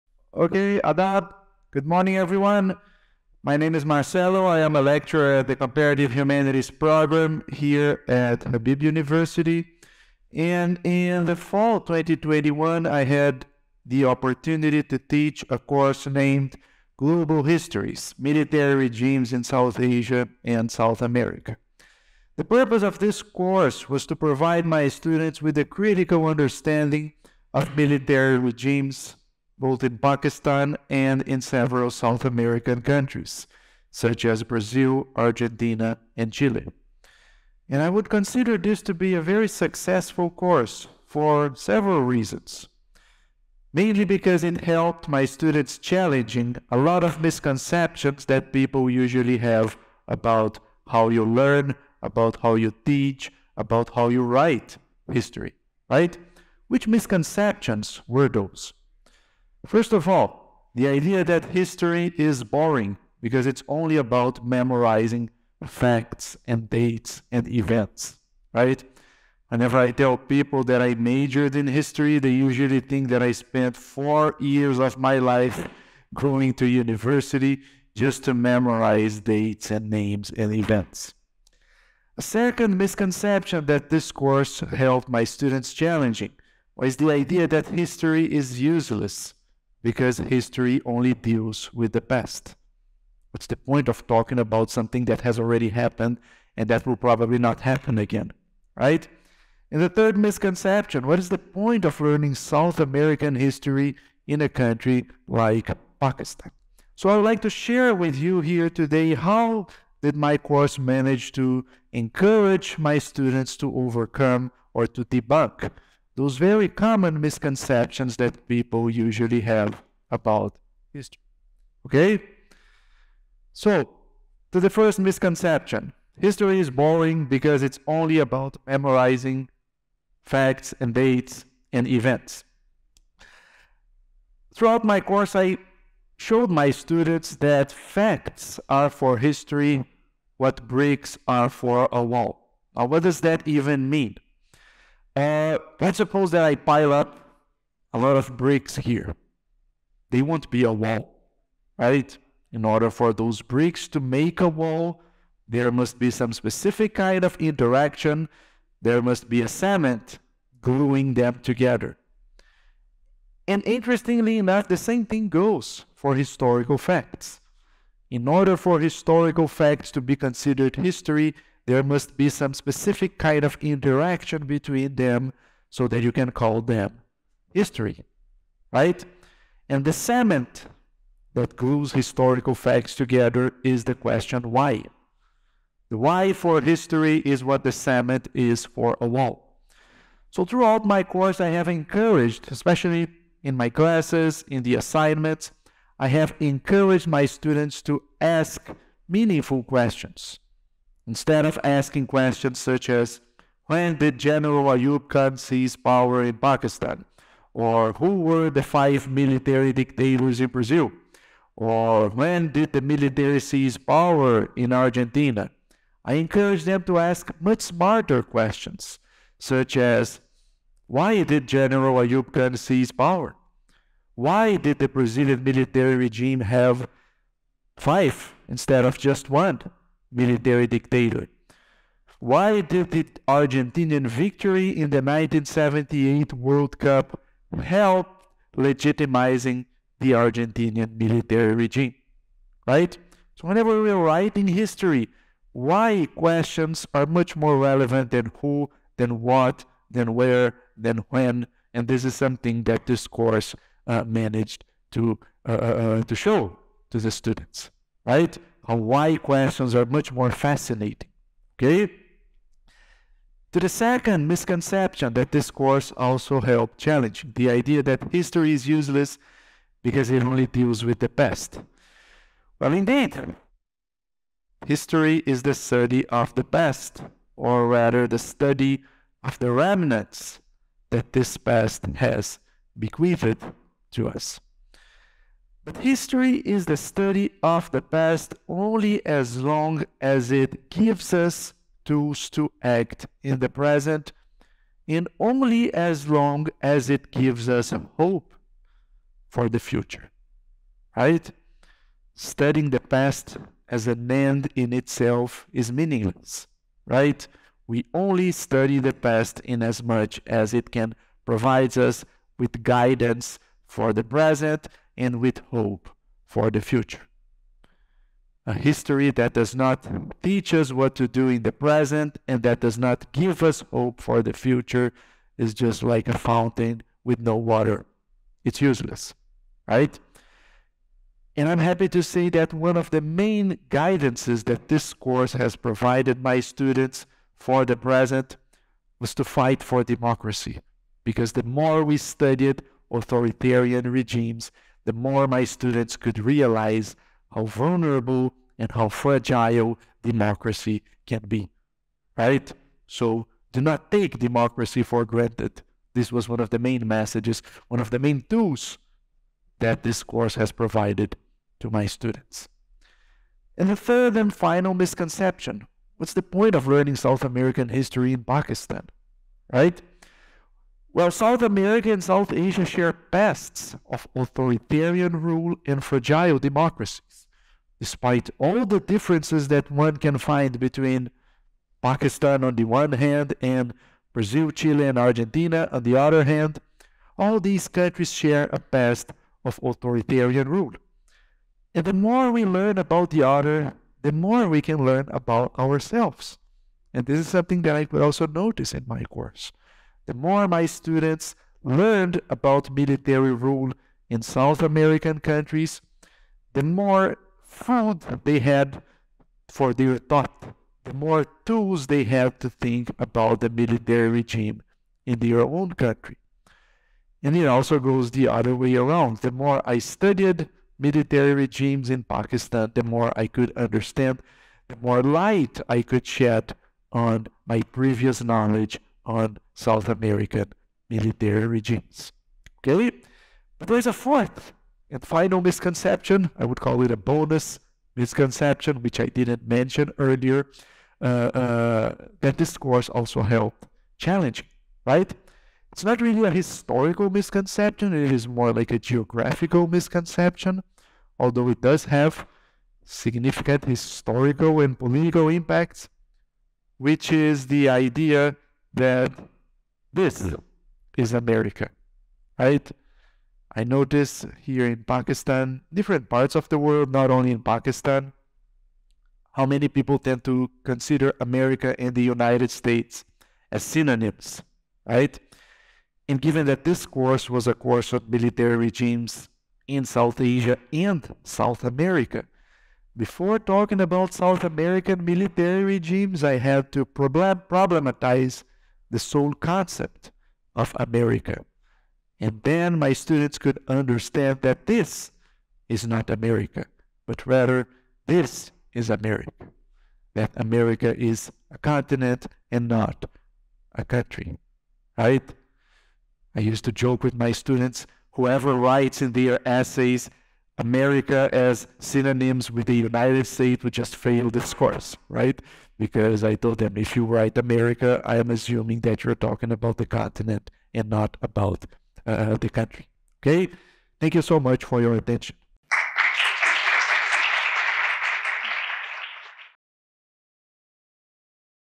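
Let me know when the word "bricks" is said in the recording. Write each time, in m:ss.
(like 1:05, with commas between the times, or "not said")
2:20, 2:28, 2:33.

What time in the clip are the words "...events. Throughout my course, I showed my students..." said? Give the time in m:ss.
2:11.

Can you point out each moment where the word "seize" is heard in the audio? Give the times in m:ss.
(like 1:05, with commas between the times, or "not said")
3:25, 3:33, 3:42.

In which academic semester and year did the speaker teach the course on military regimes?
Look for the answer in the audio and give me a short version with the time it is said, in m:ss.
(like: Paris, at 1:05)
Fall 2021, at 0:11.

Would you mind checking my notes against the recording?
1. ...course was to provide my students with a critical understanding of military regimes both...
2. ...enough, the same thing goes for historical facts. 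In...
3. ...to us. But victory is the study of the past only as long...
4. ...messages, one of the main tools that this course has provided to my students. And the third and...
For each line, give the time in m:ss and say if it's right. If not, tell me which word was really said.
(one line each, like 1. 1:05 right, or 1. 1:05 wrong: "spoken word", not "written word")
1. 0:23 right
2. 2:44 right
3. 4:43 wrong: "history", not "victory"
4. 5:56 right.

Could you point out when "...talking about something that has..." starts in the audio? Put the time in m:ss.
1:34.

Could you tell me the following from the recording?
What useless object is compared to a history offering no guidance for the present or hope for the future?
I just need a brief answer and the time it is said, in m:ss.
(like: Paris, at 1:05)
A fountain with no water, at 5:26.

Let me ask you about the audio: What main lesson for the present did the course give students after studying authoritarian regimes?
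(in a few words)
Fight for democracy.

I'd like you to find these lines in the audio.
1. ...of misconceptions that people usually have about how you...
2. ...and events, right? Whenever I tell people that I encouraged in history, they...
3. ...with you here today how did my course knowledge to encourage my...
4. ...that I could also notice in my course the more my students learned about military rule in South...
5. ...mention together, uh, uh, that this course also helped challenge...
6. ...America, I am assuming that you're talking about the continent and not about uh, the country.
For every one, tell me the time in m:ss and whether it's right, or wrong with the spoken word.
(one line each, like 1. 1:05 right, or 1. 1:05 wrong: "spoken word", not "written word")
1. 0:47 right
2. 1:07 wrong: "majored", not "encouraged"
3. 1:47 wrong: "manage", not "knowledge"
4. 6:37 right
5. 7:19 wrong: "earlier", not "together"
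6. 8:37 right.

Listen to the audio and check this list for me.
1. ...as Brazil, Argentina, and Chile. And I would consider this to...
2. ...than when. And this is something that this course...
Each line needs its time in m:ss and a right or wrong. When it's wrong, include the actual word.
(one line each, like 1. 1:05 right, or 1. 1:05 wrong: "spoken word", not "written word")
1. 0:34 right
2. 4:10 right.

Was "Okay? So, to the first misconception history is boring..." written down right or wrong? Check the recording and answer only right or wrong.
right.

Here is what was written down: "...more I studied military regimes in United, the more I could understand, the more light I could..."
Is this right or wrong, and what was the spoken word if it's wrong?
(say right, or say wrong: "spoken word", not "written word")
wrong: "Pakistan", not "United".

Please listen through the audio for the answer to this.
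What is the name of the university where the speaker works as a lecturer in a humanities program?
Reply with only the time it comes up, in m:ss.
0:08.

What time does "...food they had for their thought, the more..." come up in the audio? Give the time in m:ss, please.
6:47.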